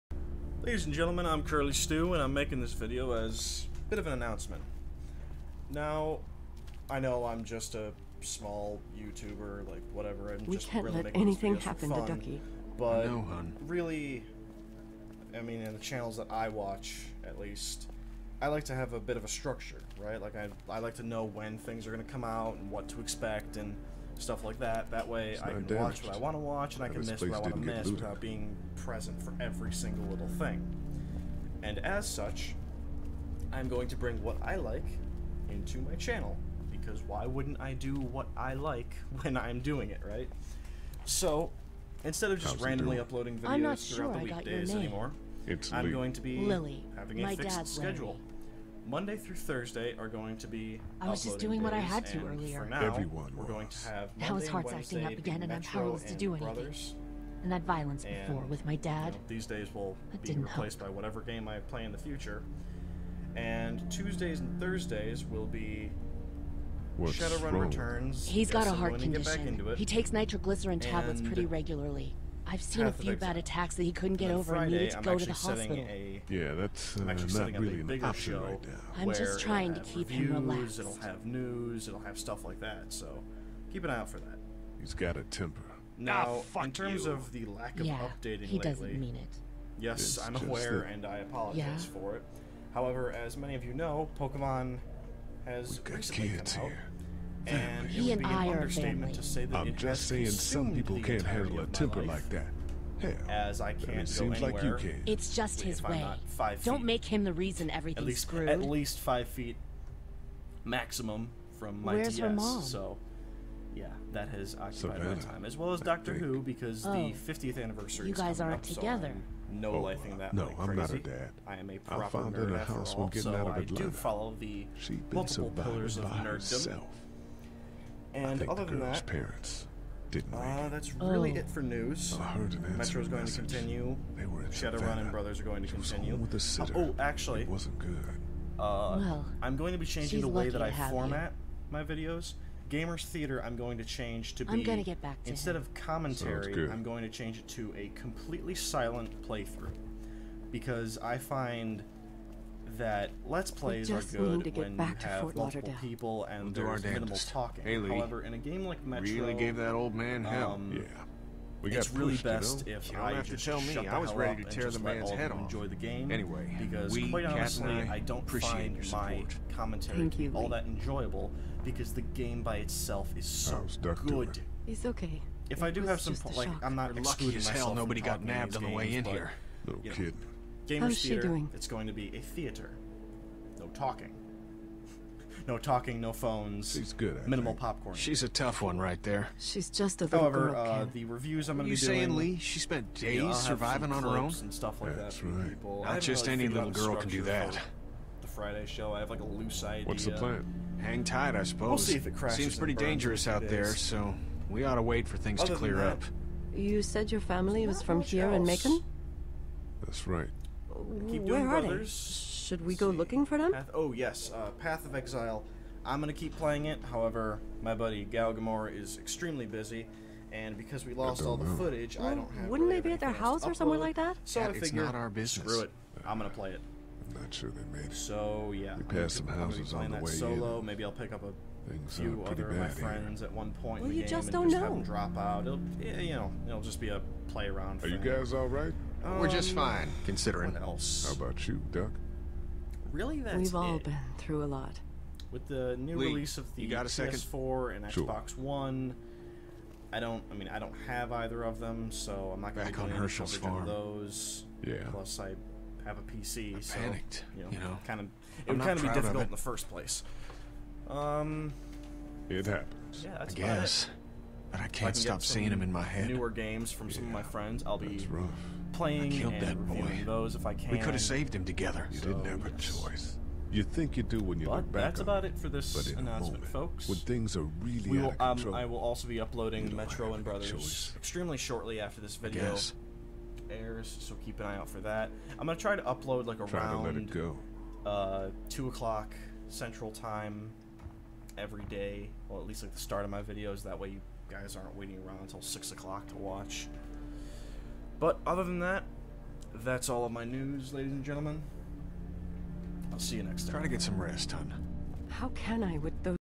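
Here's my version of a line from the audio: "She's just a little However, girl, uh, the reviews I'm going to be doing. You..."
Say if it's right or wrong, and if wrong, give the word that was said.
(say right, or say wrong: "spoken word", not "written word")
right.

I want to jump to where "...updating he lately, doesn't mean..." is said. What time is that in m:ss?
1:27.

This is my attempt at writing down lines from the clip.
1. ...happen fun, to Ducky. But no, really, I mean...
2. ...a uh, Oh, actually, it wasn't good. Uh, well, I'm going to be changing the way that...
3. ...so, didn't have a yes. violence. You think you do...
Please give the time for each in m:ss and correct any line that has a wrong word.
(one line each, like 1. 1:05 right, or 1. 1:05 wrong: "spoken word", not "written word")
1. 0:11 right
2. 2:16 right
3. 4:31 wrong: "choice", not "violence".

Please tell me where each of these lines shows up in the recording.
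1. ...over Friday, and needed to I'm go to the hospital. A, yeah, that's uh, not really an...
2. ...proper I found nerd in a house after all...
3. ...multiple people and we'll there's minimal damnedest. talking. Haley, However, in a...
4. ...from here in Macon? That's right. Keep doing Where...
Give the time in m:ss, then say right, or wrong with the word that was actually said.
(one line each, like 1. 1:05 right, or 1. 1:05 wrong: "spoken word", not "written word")
1. 1:14 right
2. 2:01 right
3. 2:35 right
4. 3:27 right.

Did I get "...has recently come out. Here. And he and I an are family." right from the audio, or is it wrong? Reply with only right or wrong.
right.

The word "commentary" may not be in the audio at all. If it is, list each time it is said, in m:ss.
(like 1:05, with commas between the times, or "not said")
2:25, 2:49.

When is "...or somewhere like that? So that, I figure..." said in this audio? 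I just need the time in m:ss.
3:43.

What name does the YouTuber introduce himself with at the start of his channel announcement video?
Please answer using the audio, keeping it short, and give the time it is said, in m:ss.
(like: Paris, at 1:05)
Curly Stew, at 0:01.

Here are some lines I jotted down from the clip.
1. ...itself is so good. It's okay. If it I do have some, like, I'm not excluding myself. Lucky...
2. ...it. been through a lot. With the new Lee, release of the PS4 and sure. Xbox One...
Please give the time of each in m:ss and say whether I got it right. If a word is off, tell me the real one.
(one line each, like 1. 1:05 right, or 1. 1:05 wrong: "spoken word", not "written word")
1. 2:52 right
2. 4:03 right.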